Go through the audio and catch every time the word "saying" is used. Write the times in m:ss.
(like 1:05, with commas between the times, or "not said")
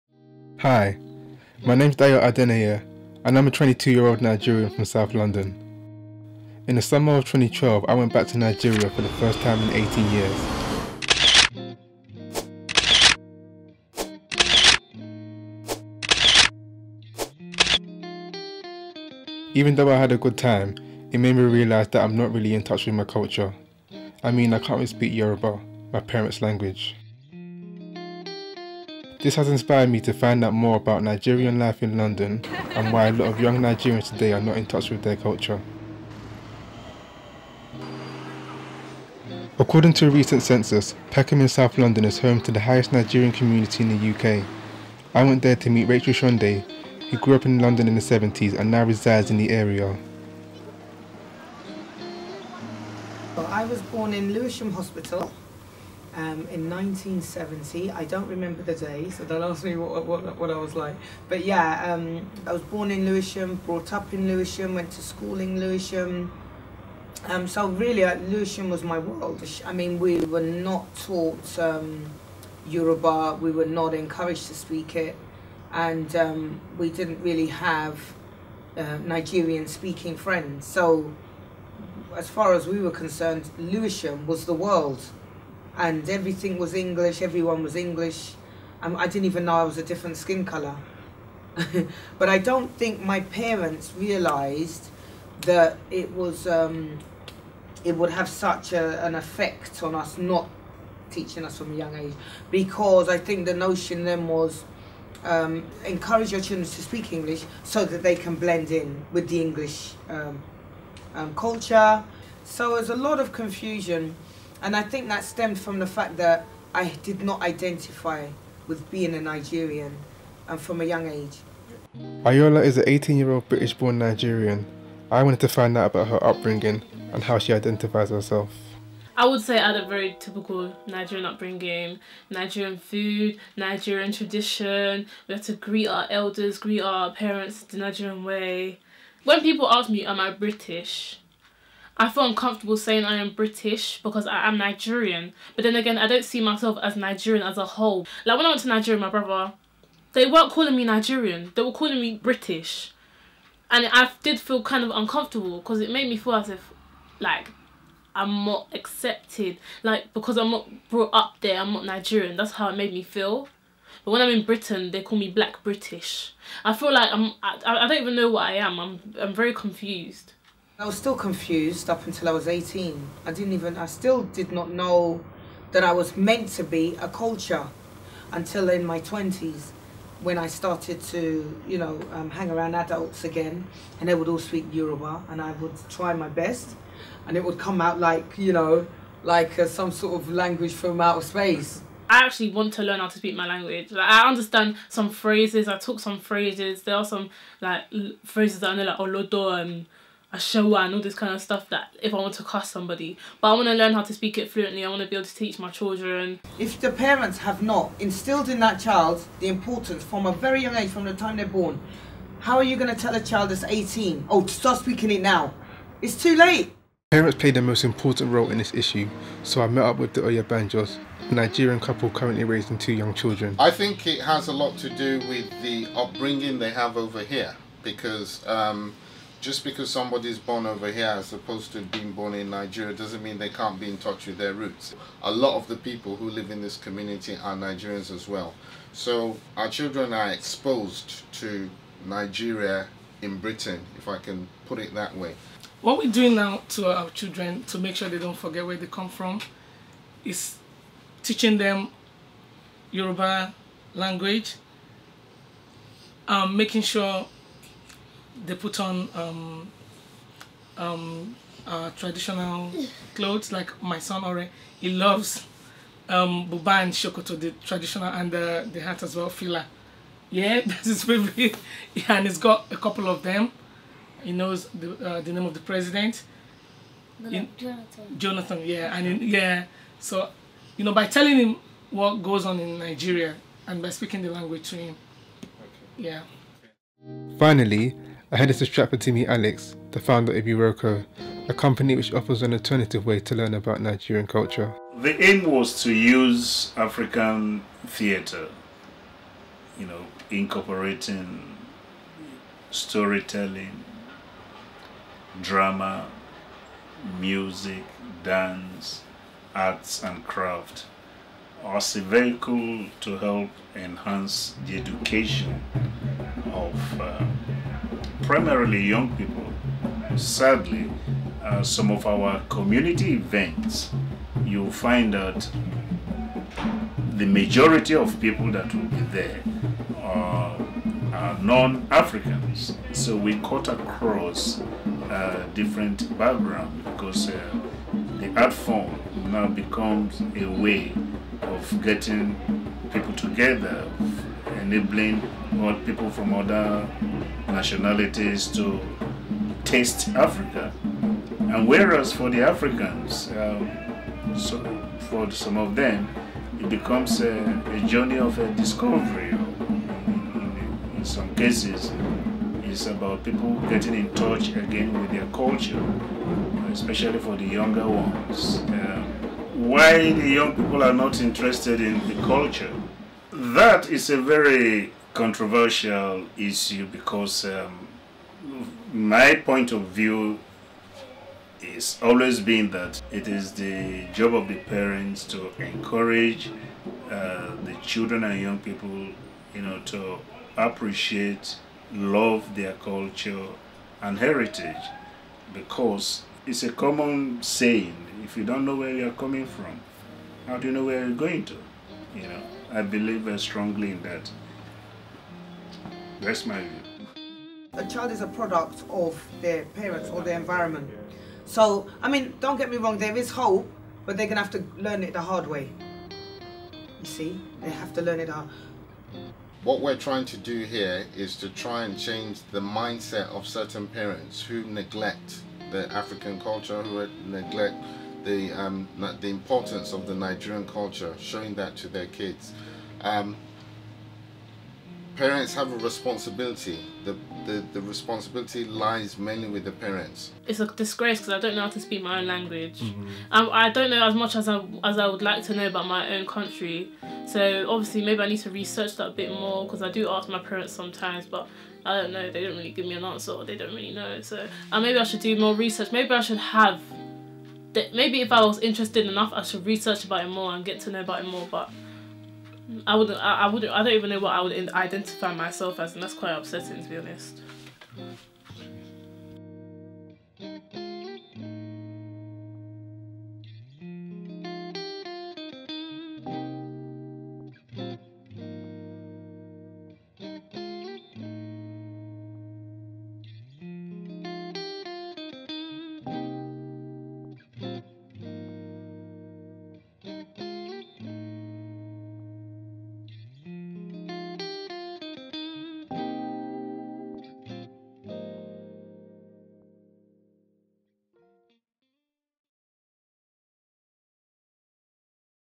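2:22, 6:37.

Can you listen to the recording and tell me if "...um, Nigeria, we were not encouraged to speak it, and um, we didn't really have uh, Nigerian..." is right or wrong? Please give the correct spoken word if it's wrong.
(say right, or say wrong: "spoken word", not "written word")
wrong: "Yoruba", not "Nigeria".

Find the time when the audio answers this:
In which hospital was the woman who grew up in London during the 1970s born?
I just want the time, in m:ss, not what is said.
0:54.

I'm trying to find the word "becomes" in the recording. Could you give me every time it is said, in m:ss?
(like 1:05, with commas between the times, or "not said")
5:39, 5:56.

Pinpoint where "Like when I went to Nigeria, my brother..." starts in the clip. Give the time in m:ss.
2:28.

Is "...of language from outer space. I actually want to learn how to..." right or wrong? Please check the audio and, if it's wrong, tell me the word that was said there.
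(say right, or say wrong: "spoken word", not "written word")
right.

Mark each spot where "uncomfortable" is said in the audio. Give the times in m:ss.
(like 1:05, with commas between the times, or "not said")
2:22, 2:34.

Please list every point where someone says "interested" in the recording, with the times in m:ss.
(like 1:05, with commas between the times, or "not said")
6:11, 7:38.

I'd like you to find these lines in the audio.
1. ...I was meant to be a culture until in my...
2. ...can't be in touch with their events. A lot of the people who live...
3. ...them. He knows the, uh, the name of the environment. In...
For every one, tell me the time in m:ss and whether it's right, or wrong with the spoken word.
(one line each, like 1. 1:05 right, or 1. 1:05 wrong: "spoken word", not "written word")
1. 2:55 right
2. 3:53 wrong: "roots", not "events"
3. 4:33 wrong: "president", not "environment".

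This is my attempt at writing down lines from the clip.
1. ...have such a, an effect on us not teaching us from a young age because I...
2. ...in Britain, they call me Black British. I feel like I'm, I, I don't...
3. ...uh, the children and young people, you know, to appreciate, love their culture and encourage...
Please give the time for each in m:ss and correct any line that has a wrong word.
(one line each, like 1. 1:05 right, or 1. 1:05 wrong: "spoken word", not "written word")
1. 1:38 right
2. 2:44 right
3. 6:27 wrong: "heritage", not "encourage".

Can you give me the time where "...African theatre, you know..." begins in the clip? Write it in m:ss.
4:56.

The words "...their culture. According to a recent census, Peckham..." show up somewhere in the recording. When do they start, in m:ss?
0:35.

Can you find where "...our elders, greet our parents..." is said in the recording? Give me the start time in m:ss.
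2:15.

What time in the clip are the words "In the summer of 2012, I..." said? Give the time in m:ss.
0:06.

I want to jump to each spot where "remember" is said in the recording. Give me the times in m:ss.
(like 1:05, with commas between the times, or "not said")
0:58.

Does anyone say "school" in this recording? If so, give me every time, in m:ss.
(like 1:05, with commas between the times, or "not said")
1:05.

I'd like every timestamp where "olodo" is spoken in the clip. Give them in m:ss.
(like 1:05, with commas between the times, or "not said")
3:18.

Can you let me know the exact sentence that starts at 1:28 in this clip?
Um, I didn't even know I was a different skin colour.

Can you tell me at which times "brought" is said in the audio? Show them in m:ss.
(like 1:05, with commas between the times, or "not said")
1:03, 2:40.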